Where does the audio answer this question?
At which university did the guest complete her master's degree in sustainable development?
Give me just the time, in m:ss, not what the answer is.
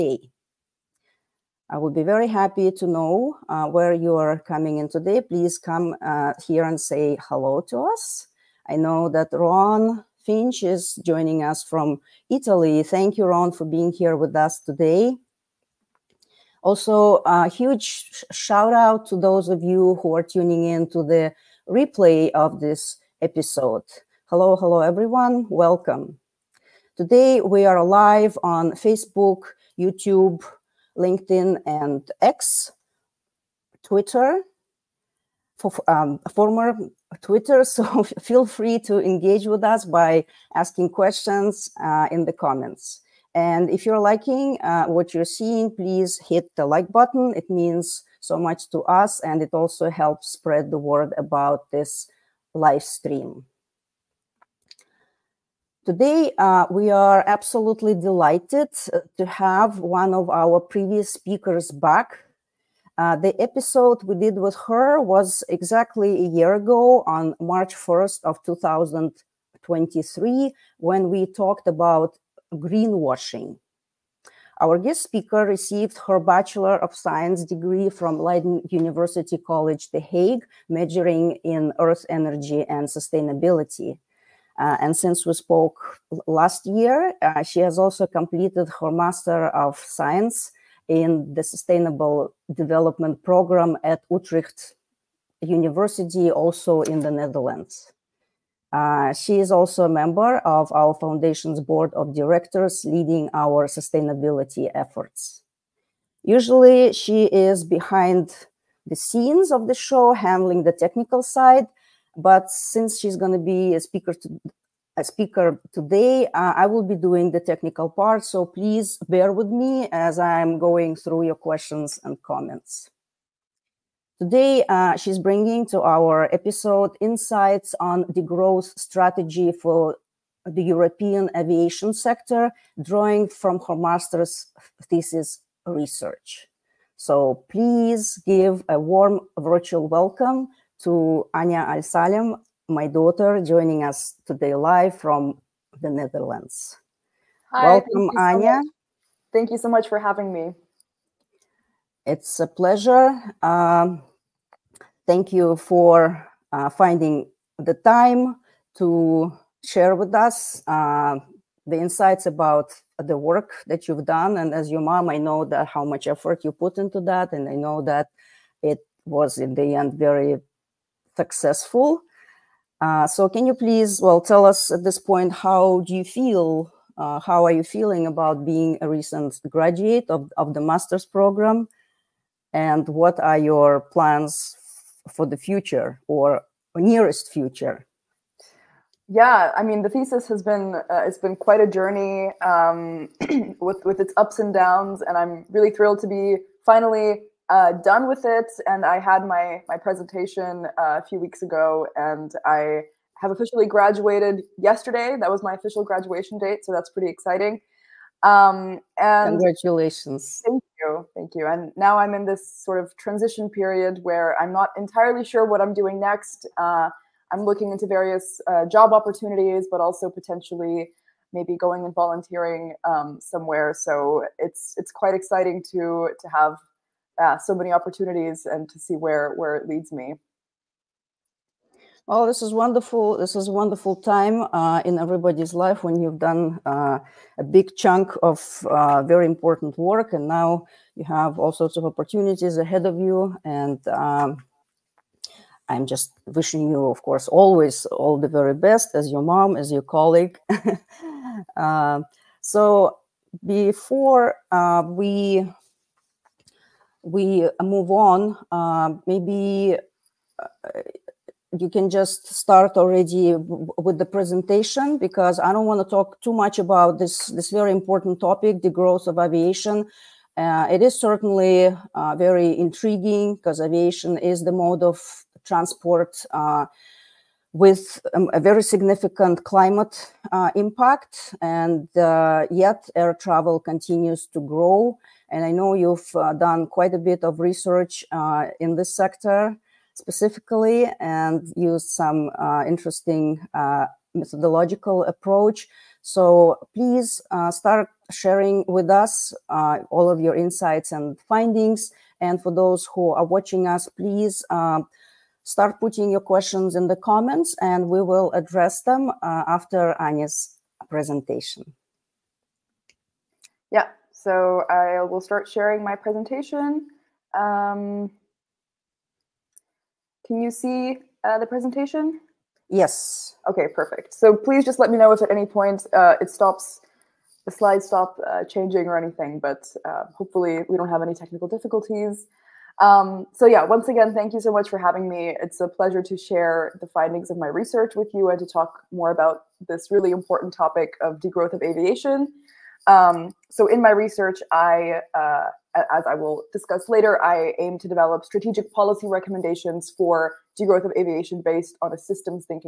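1:34.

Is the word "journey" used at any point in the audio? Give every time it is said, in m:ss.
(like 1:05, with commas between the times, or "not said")
3:11.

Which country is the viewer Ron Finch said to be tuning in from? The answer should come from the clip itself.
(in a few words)
Italy.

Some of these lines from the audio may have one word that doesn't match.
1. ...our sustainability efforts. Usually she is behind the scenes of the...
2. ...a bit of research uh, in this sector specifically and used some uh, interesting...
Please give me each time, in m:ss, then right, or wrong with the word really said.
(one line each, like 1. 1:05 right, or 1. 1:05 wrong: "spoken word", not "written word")
1. 1:43 right
2. 4:46 right.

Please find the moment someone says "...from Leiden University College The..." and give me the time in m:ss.
1:17.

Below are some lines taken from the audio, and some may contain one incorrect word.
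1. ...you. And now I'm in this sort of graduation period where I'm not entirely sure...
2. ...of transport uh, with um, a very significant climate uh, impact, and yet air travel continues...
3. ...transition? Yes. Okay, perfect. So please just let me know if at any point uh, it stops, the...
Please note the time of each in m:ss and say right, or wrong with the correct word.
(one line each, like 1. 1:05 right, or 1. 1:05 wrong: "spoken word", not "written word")
1. 3:31 wrong: "transition", not "graduation"
2. 4:34 right
3. 5:21 wrong: "presentation", not "transition".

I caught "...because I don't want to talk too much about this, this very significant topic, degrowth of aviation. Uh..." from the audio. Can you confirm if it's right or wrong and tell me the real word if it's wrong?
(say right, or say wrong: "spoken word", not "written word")
wrong: "important", not "significant".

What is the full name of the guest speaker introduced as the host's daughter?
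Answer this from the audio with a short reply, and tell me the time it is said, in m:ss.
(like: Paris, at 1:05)
Anya Al Salem, at 2:21.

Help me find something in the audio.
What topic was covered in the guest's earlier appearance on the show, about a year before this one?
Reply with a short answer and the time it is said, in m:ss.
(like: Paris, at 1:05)
Greenwashing, at 1:12.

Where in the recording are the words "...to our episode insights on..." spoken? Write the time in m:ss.
2:05.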